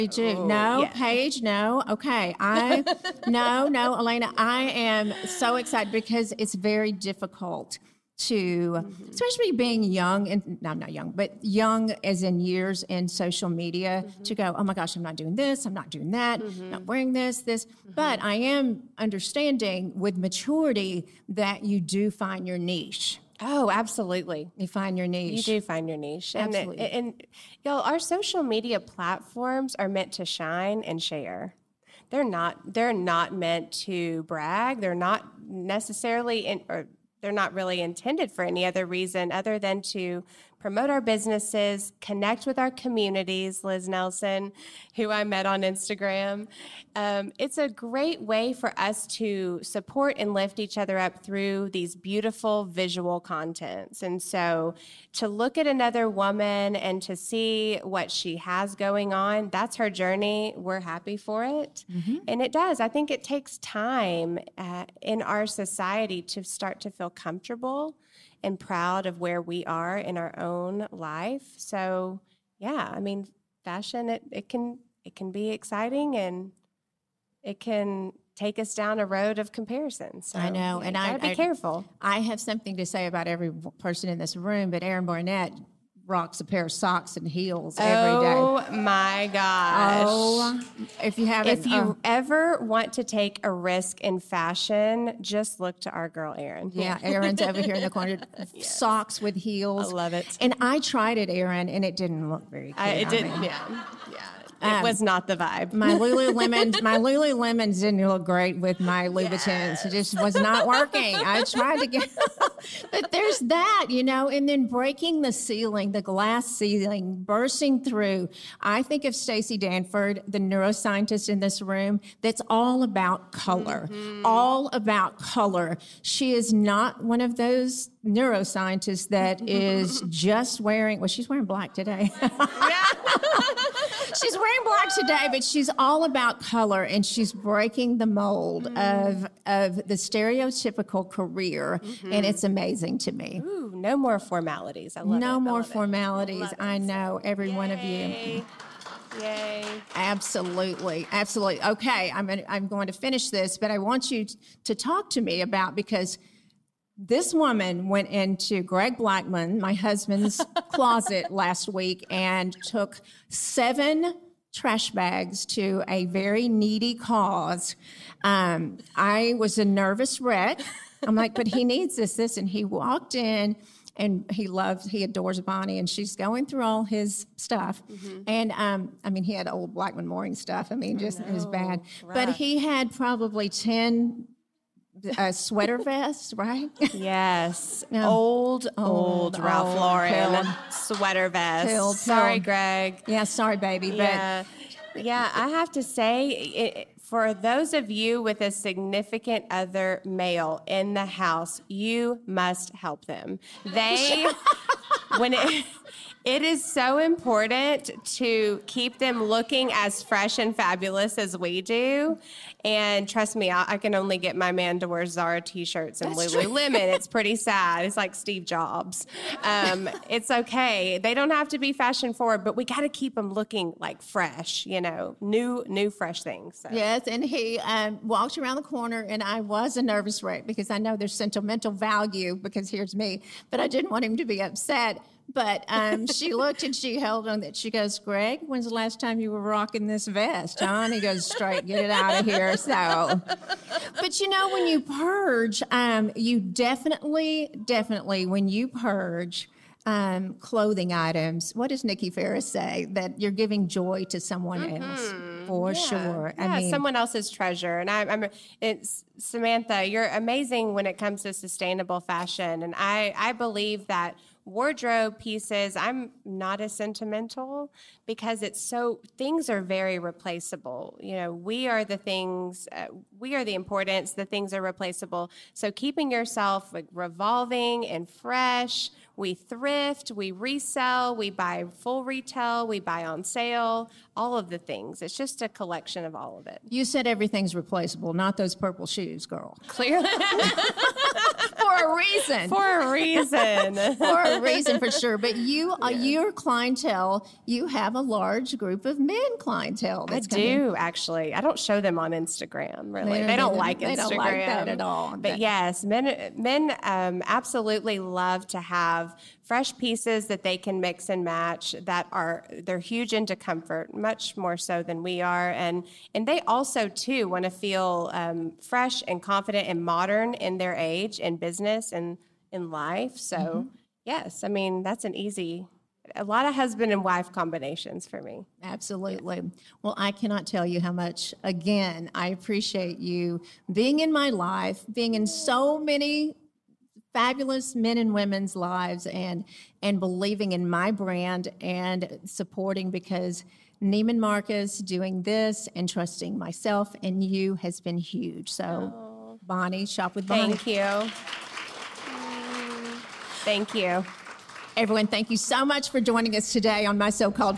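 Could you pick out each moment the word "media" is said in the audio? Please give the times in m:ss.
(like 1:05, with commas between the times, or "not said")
0:13, 0:28.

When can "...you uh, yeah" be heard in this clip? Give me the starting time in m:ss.
4:55.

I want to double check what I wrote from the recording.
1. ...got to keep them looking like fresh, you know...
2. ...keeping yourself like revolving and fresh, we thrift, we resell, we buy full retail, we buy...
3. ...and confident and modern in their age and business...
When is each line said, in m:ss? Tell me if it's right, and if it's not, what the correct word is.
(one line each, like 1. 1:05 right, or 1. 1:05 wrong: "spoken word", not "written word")
1. 3:42 right
2. 4:35 right
3. 5:19 right.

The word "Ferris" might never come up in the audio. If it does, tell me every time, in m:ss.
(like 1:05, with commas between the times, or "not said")
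4:12.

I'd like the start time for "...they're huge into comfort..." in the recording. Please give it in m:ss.
5:12.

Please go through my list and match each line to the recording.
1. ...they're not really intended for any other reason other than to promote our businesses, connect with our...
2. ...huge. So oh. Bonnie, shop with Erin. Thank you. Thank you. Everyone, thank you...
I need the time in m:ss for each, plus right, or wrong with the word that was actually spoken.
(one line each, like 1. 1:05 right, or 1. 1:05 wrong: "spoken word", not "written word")
1. 0:37 right
2. 5:47 wrong: "Bonnie", not "Erin".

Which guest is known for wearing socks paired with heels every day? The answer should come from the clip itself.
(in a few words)
Aaron Barnett.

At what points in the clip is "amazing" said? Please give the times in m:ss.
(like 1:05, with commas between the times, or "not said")
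2:22, 4:20.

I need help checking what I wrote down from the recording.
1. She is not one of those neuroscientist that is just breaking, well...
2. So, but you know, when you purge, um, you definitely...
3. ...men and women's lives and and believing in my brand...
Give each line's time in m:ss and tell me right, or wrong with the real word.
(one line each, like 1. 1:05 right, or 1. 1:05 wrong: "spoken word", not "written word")
1. 2:06 wrong: "wearing", not "breaking"
2. 4:02 right
3. 5:37 right.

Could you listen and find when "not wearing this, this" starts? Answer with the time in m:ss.
0:16.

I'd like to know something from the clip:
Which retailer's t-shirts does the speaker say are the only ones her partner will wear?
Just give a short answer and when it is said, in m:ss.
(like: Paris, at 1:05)
Zara, at 3:35.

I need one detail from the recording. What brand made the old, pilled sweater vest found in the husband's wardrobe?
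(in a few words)
Ralph Lauren.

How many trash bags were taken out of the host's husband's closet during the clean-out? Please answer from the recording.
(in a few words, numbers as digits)
7.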